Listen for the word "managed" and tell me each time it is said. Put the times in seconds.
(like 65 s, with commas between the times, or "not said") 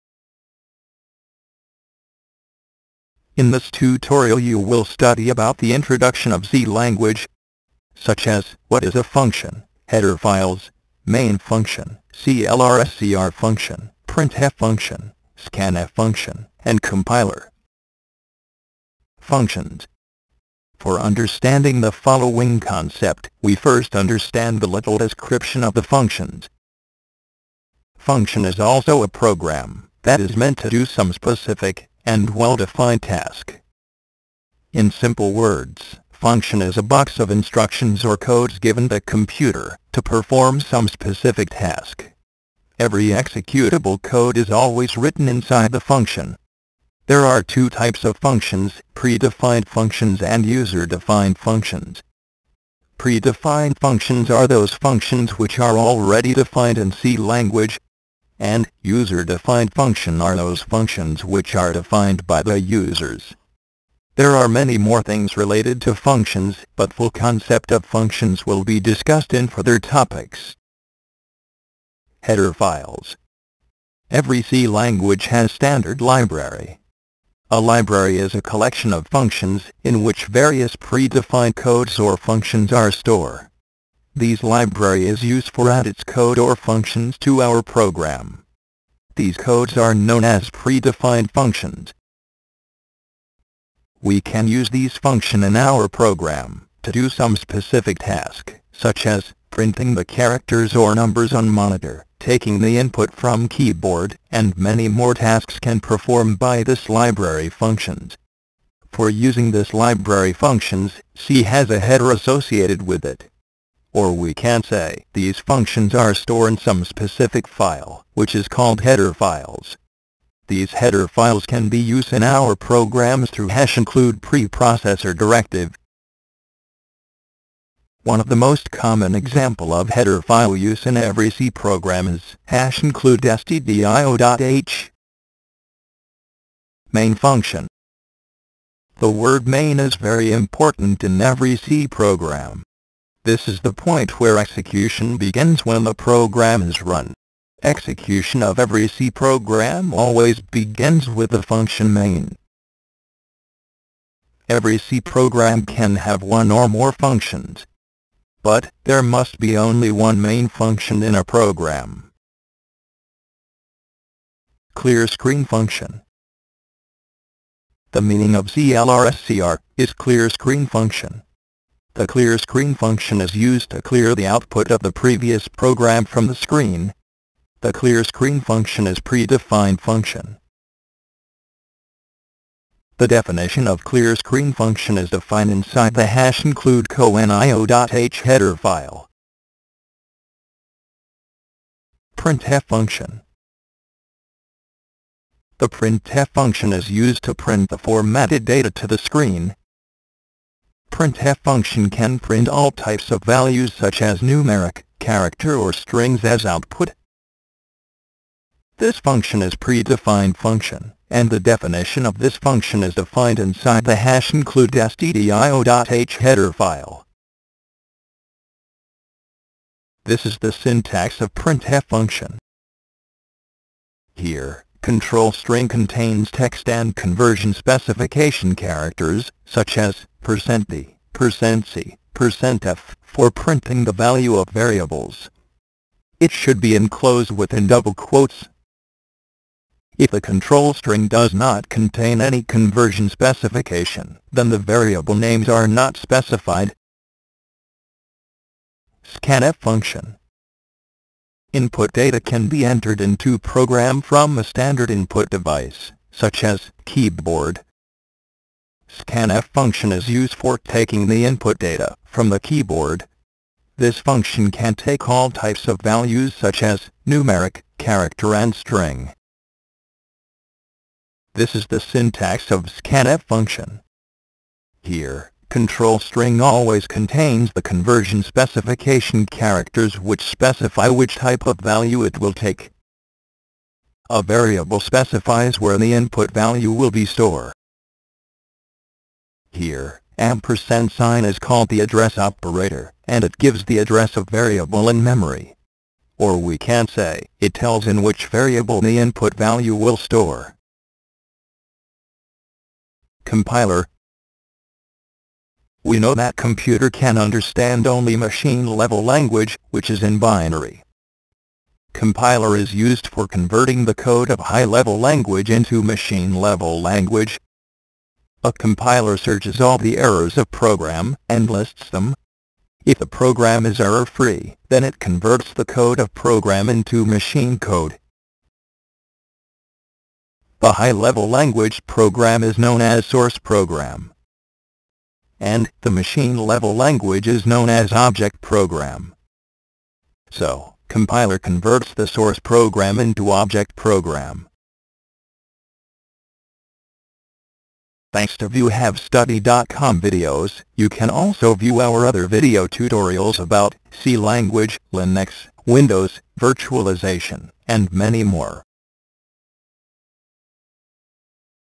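not said.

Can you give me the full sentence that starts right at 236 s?
It should be enclosed within double quotes.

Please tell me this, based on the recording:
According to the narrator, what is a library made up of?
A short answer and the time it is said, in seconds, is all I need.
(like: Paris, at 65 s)
A collection of functions, at 78 s.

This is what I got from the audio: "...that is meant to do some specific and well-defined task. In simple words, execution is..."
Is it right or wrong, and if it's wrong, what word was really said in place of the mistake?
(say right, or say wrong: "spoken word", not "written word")
wrong: "function", not "execution".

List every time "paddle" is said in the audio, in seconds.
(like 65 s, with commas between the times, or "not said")
not said.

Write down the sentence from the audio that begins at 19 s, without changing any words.
Functions For understanding the following concept, we first understand the little description of the functions.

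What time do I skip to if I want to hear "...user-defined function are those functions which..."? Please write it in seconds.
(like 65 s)
58 s.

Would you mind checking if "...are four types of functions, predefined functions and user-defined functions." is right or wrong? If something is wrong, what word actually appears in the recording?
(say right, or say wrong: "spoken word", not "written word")
wrong: "two", not "four".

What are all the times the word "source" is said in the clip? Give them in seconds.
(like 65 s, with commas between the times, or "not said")
333 s, 342 s.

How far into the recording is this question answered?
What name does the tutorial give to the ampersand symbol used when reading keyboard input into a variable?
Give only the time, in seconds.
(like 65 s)
291 s.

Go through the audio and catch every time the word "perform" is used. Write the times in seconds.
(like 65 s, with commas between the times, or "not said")
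40 s, 105 s.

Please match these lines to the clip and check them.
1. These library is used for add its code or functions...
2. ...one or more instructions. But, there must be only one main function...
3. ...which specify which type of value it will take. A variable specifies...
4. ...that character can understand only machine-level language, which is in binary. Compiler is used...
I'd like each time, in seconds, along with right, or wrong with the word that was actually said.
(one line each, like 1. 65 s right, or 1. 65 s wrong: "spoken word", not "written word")
1. 84 s right
2. 156 s wrong: "functions", not "instructions"
3. 279 s right
4. 306 s wrong: "computer", not "character".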